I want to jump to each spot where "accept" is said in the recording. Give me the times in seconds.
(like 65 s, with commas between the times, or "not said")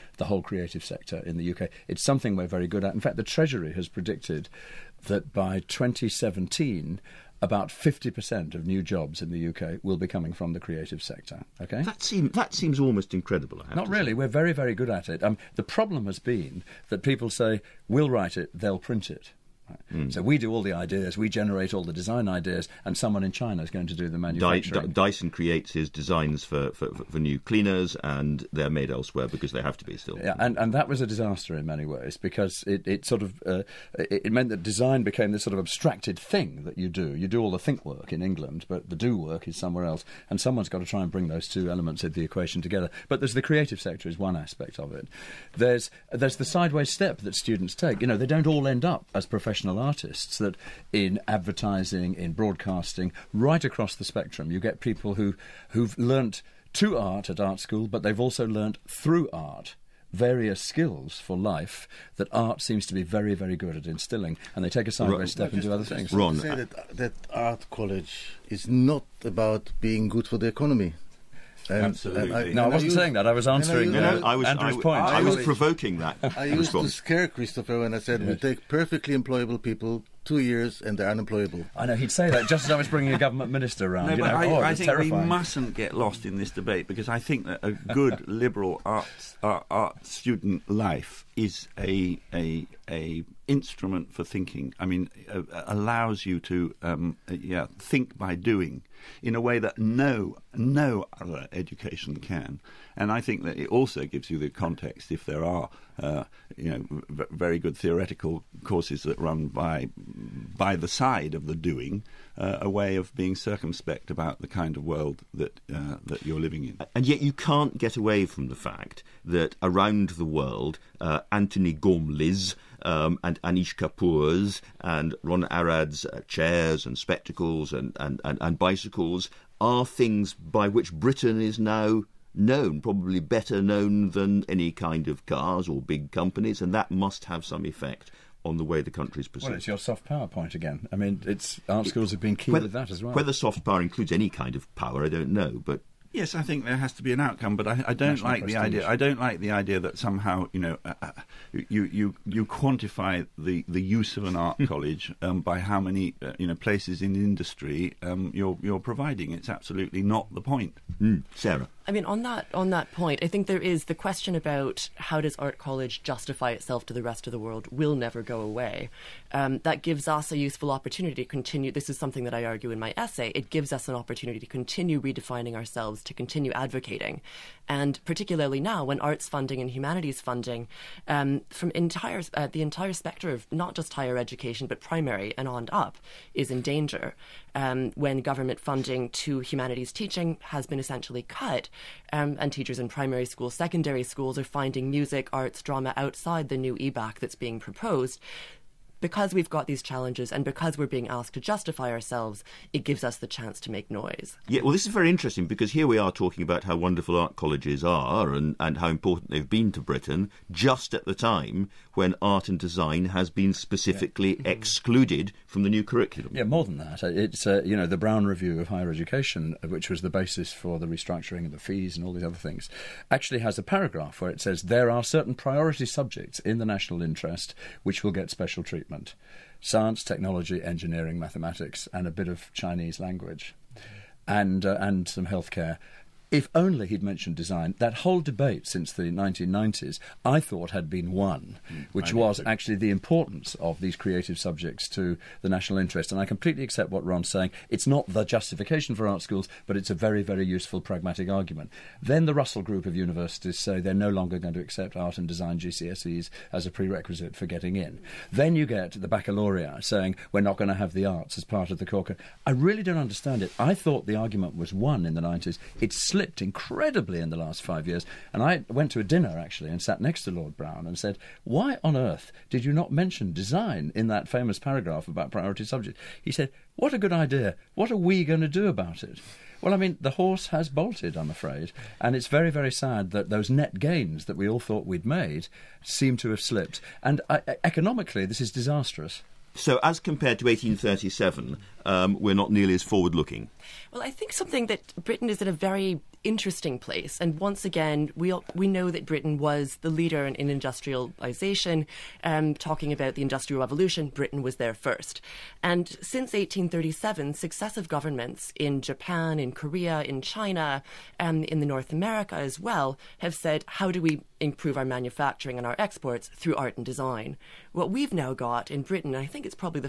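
246 s, 254 s.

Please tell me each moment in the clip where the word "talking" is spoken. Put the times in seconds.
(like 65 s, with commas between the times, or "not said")
206 s, 302 s.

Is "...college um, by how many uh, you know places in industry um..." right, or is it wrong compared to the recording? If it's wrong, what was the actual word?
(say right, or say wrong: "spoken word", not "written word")
right.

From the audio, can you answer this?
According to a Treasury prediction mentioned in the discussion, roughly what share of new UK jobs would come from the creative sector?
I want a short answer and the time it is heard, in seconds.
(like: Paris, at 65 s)
50%, at 7 s.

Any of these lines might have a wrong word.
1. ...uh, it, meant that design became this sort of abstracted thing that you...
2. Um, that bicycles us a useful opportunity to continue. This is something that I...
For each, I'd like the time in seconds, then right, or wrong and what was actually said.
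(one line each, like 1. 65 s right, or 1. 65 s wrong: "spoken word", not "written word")
1. 33 s right
2. 169 s wrong: "gives", not "bicycles".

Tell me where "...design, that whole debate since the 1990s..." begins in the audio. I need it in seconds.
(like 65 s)
237 s.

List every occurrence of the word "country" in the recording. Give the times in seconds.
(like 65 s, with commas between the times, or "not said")
138 s.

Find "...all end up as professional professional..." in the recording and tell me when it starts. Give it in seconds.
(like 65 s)
48 s.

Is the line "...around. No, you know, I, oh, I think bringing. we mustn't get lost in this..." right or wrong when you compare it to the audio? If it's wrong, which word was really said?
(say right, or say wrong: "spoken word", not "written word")
wrong: "terrifying", not "bringing".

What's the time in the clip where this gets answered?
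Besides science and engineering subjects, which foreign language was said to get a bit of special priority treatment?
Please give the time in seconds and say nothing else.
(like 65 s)
232 s.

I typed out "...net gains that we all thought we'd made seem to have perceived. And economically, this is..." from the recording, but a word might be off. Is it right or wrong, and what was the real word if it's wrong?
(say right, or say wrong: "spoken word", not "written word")
wrong: "slipped", not "perceived".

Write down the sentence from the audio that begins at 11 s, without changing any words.
Okay, that seems that seems almost incredible.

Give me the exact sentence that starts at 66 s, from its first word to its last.
Ron, say that, that art college is not about being good for the economy.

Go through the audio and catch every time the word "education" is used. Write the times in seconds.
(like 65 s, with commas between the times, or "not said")
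101 s, 184 s, 218 s.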